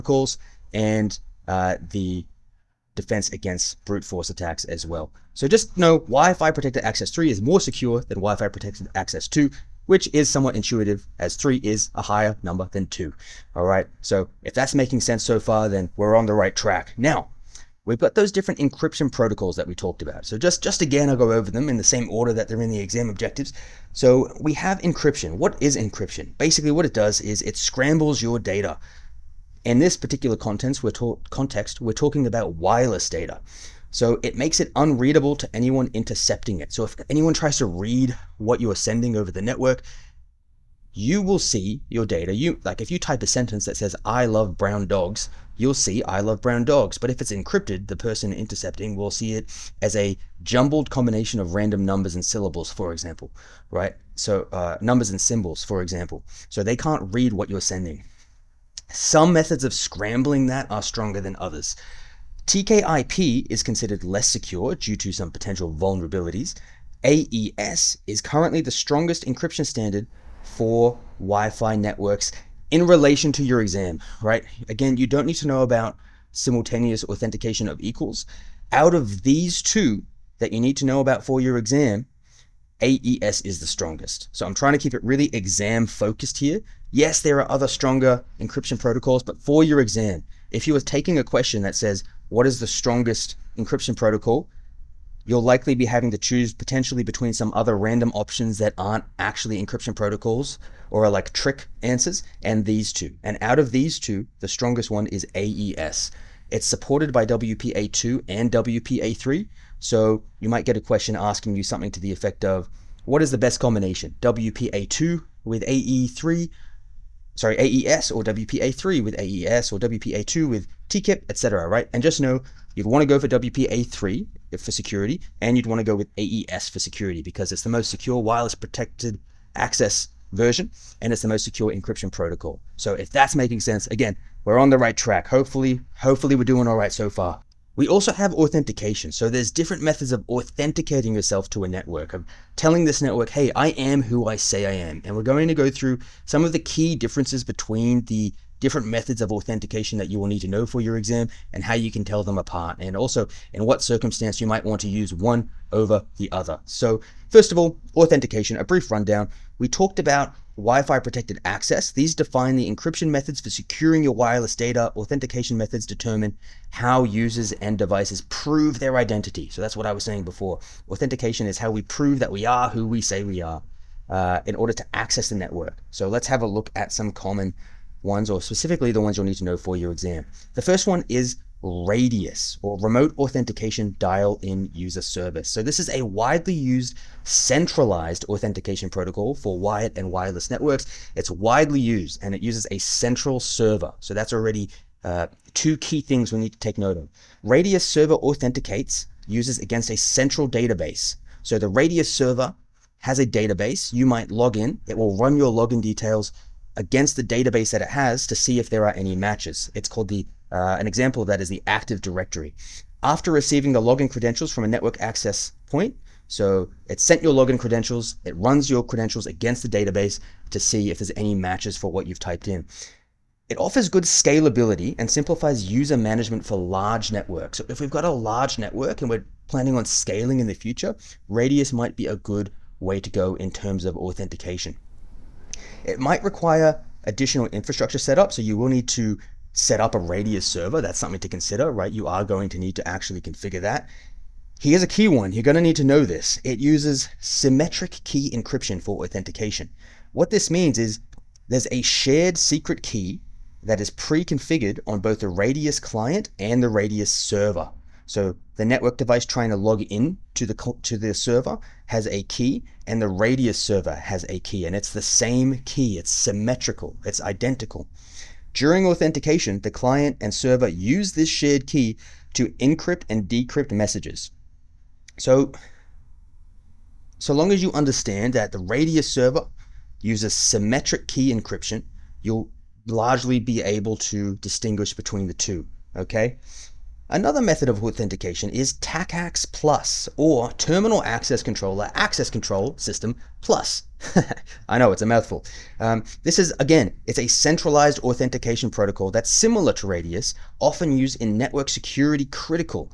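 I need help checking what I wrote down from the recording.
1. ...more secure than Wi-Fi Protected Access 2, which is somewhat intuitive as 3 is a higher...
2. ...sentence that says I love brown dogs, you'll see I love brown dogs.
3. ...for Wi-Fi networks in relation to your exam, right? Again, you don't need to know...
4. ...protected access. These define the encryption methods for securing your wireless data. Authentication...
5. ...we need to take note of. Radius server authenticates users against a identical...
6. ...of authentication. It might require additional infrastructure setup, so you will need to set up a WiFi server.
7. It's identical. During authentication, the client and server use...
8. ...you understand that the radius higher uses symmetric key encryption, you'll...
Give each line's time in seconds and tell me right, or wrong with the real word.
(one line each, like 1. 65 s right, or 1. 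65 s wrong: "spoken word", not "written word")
1. 7 s right
2. 43 s right
3. 70 s right
4. 160 s right
5. 196 s wrong: "central", not "identical"
6. 233 s wrong: "Radius", not "WiFi"
7. 267 s right
8. 277 s wrong: "server", not "higher".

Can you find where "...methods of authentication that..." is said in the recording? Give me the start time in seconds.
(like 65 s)
148 s.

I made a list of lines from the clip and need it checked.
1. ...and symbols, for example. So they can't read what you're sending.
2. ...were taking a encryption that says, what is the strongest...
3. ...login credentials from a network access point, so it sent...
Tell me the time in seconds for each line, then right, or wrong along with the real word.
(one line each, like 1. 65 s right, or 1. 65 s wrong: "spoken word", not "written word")
1. 55 s right
2. 90 s wrong: "question", not "encryption"
3. 213 s right.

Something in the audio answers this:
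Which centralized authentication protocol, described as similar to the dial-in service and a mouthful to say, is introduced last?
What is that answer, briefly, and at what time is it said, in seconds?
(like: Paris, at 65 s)
TACACS Plus, at 288 s.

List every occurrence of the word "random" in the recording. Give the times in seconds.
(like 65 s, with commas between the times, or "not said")
51 s, 97 s.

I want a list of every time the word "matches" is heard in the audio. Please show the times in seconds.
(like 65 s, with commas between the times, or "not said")
209 s, 221 s.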